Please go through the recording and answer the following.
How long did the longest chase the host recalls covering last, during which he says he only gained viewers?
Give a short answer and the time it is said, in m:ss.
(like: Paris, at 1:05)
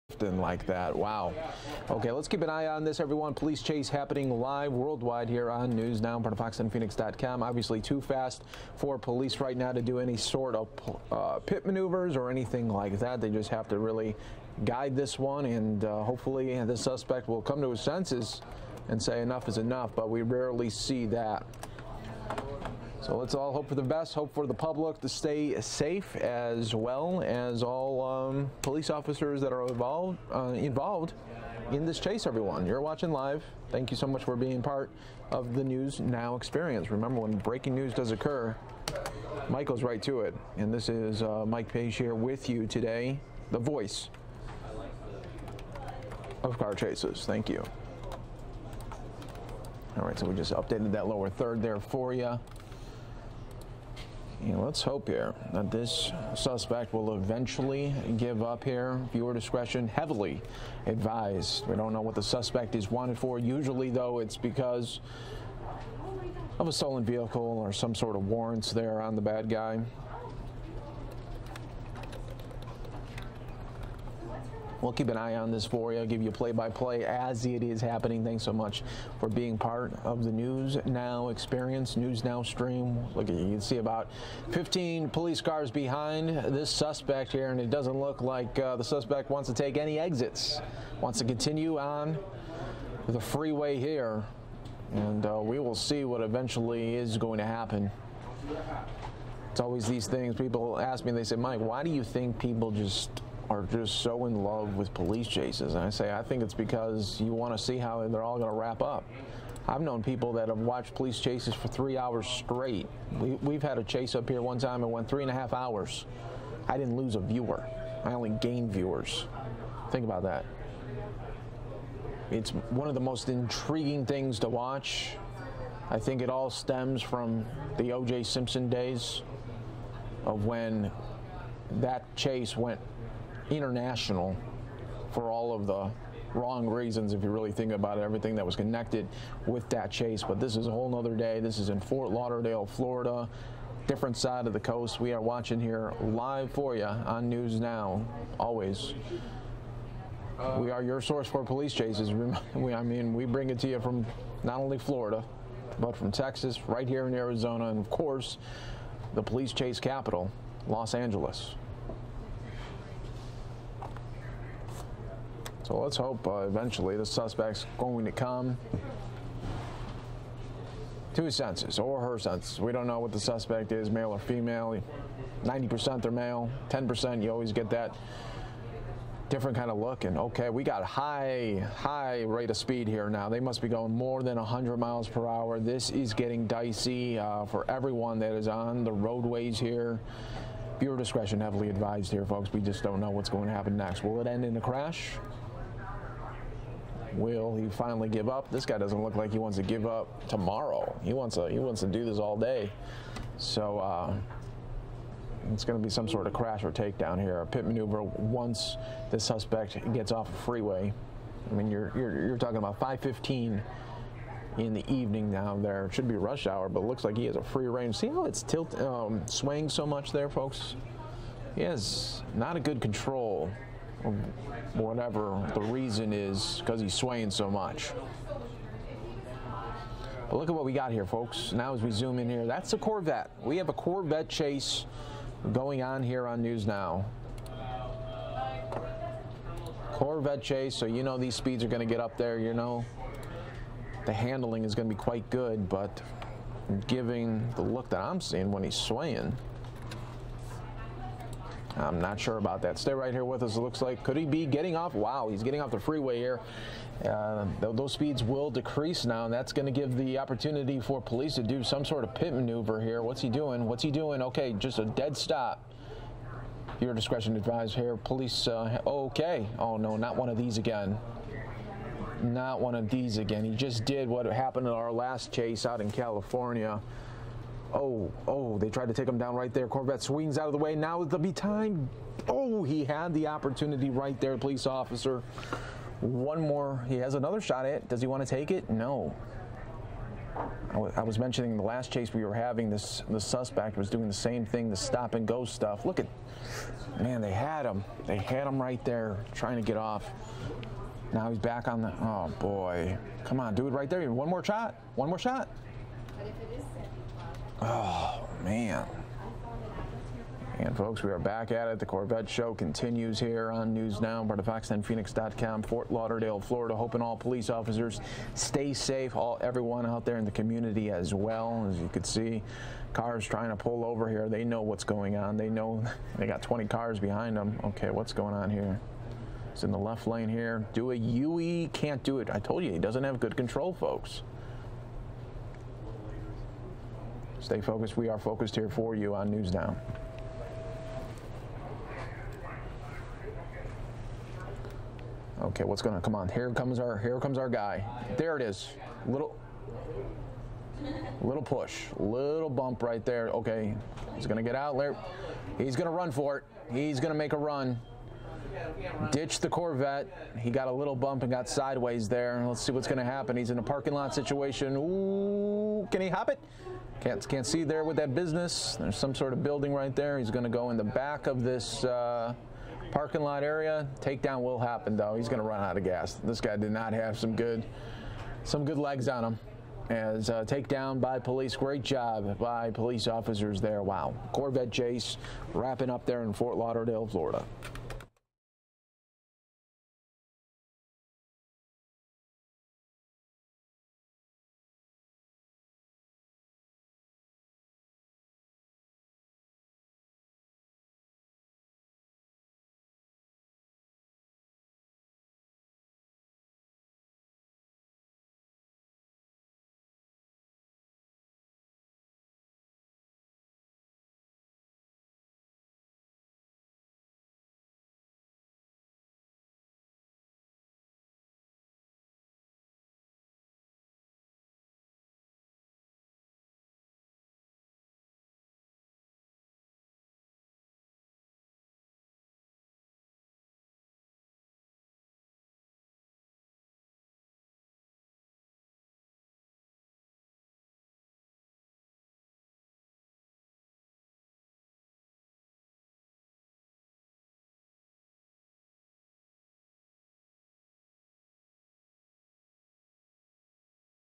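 3.5 hours, at 1:55.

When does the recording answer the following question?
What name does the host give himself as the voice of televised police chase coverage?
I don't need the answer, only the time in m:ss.
0:41.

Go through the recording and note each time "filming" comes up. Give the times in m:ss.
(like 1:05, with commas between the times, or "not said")
not said.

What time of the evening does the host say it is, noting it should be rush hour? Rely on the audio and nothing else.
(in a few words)
5:15.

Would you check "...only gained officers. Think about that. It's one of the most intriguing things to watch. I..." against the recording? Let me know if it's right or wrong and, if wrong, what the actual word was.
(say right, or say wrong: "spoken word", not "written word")
wrong: "viewers", not "officers".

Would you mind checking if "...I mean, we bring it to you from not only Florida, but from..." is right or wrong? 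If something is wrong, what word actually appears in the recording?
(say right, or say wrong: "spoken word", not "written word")
right.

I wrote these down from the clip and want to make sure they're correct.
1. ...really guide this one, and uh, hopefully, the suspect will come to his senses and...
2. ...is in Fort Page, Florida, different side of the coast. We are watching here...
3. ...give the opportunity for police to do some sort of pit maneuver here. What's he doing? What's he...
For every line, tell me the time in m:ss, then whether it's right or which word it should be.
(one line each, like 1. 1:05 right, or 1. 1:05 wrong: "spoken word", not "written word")
1. 0:13 right
2. 2:21 wrong: "Lauderdale", not "Page"
3. 4:19 right.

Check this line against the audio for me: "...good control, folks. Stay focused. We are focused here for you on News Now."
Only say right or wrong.
right.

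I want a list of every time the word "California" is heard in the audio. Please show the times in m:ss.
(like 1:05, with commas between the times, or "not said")
4:35.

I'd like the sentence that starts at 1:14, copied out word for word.
We'll keep an eye on this for you, give you play by play as it is happening.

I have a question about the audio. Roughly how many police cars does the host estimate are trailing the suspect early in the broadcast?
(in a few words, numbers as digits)
15.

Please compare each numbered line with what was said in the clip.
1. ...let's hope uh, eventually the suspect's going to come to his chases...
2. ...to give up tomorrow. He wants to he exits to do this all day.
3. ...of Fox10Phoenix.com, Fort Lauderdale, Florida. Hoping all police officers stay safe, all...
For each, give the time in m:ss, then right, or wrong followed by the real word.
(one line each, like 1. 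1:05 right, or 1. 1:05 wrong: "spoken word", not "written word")
1. 2:45 wrong: "senses", not "chases"
2. 3:19 wrong: "wants", not "exits"
3. 5:14 right.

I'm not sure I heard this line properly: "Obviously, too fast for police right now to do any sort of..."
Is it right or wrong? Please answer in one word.
right.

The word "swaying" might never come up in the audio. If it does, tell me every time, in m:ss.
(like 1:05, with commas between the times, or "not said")
3:39, 3:46, 4:08.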